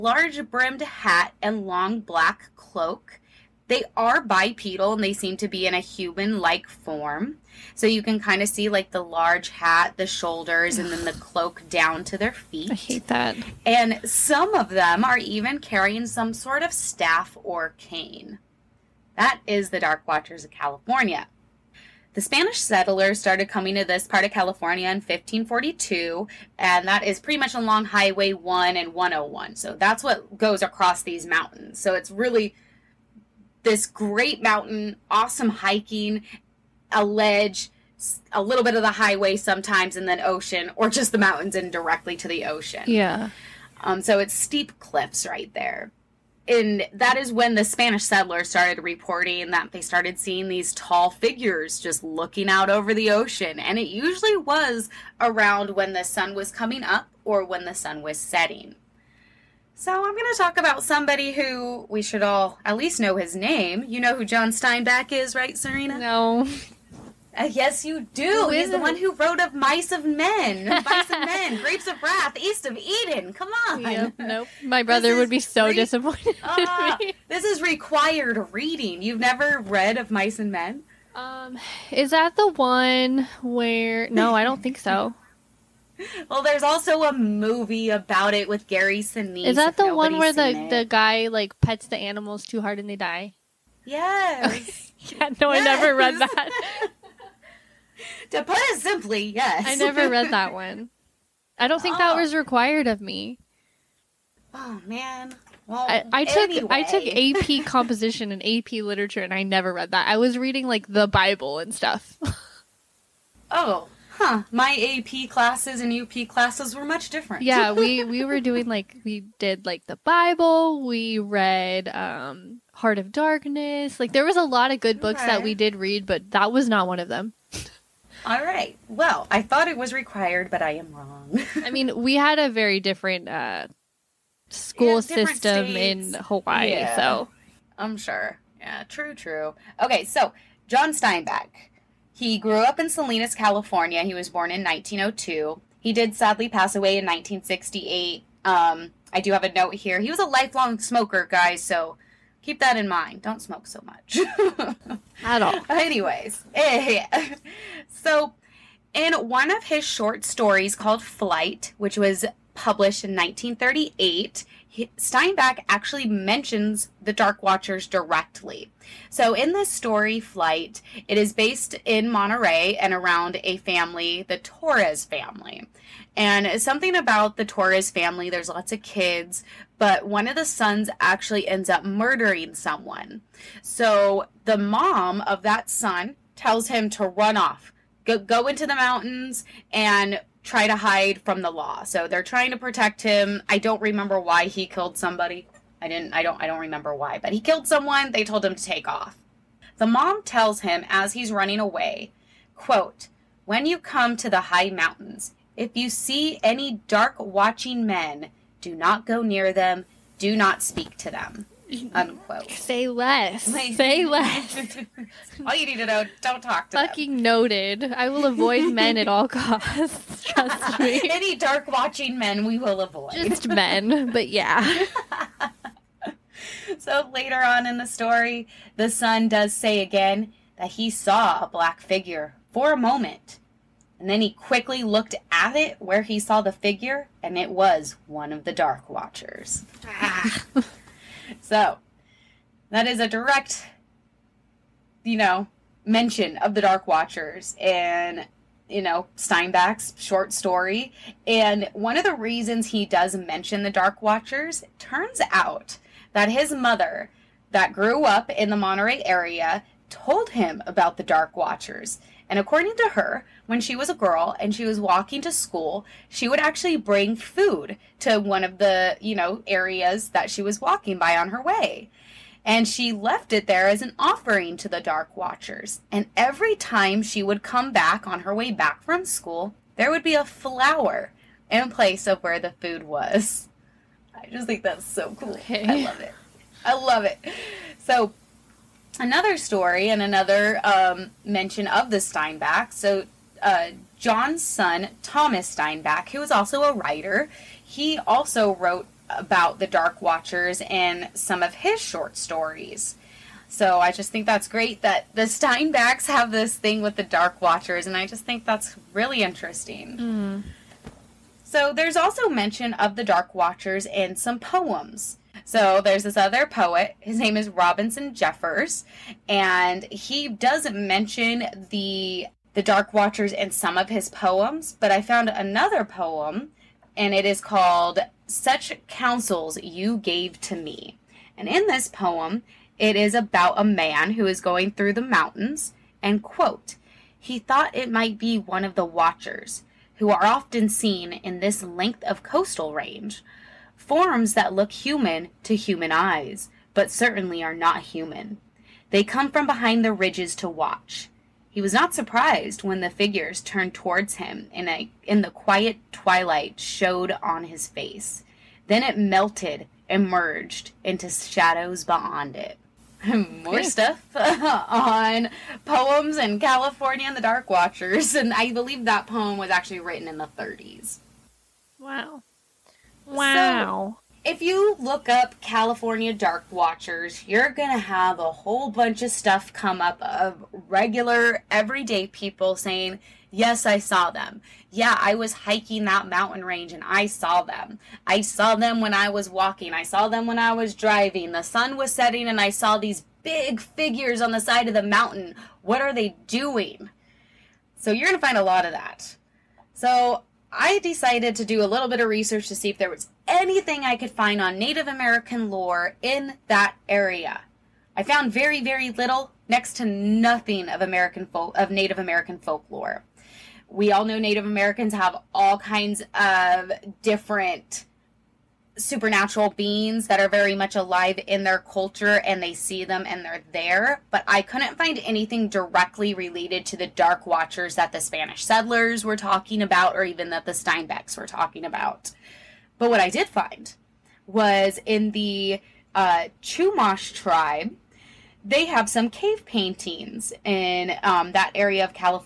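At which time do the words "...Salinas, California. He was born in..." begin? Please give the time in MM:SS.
02:22.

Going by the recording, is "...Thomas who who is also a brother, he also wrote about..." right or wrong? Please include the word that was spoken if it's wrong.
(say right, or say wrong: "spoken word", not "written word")
wrong: "writer", not "brother".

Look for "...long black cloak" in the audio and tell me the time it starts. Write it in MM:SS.
00:01.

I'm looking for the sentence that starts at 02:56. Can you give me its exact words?
And something about the Torres family, there's lots of kids, but one of the sons actually ends up murdering someone.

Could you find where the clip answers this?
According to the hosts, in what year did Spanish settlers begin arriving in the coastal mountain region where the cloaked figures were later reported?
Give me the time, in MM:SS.
00:24.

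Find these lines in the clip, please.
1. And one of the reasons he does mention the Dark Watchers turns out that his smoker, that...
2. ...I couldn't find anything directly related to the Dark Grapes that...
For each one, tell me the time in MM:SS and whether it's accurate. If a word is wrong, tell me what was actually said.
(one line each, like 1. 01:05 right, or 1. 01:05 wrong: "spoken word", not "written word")
1. 04:11 wrong: "mother", not "smoker"
2. 07:04 wrong: "Watchers", not "Grapes".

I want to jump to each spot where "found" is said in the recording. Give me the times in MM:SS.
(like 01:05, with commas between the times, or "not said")
05:25, 06:48.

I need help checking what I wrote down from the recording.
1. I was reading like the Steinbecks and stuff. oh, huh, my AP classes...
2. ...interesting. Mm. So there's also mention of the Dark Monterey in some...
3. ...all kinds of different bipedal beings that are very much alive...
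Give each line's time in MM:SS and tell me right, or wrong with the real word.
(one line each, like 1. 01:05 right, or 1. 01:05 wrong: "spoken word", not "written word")
1. 01:50 wrong: "Bible", not "Steinbecks"
2. 05:09 wrong: "Watchers", not "Monterey"
3. 06:55 wrong: "supernatural", not "bipedal".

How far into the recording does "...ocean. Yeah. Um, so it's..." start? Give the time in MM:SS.
00:42.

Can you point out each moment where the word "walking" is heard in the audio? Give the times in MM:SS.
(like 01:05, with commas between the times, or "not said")
04:24, 04:30, 06:29.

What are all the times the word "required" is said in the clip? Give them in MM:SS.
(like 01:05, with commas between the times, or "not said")
01:17, 01:42, 02:09.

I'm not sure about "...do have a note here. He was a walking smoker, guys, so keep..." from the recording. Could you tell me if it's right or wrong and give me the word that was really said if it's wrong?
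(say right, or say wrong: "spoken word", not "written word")
wrong: "lifelong", not "walking".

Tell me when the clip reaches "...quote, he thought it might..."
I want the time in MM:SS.
05:36.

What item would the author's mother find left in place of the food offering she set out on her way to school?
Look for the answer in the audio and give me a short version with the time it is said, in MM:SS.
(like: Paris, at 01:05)
A flower, at 04:40.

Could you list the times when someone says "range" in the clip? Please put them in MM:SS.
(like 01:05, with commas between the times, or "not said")
05:42, 06:26.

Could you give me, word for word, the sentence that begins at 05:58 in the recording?
Then it melted and merged into shadows beyond it.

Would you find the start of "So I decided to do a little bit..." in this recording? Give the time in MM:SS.
06:39.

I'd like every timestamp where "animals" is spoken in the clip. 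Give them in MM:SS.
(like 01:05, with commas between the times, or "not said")
01:31.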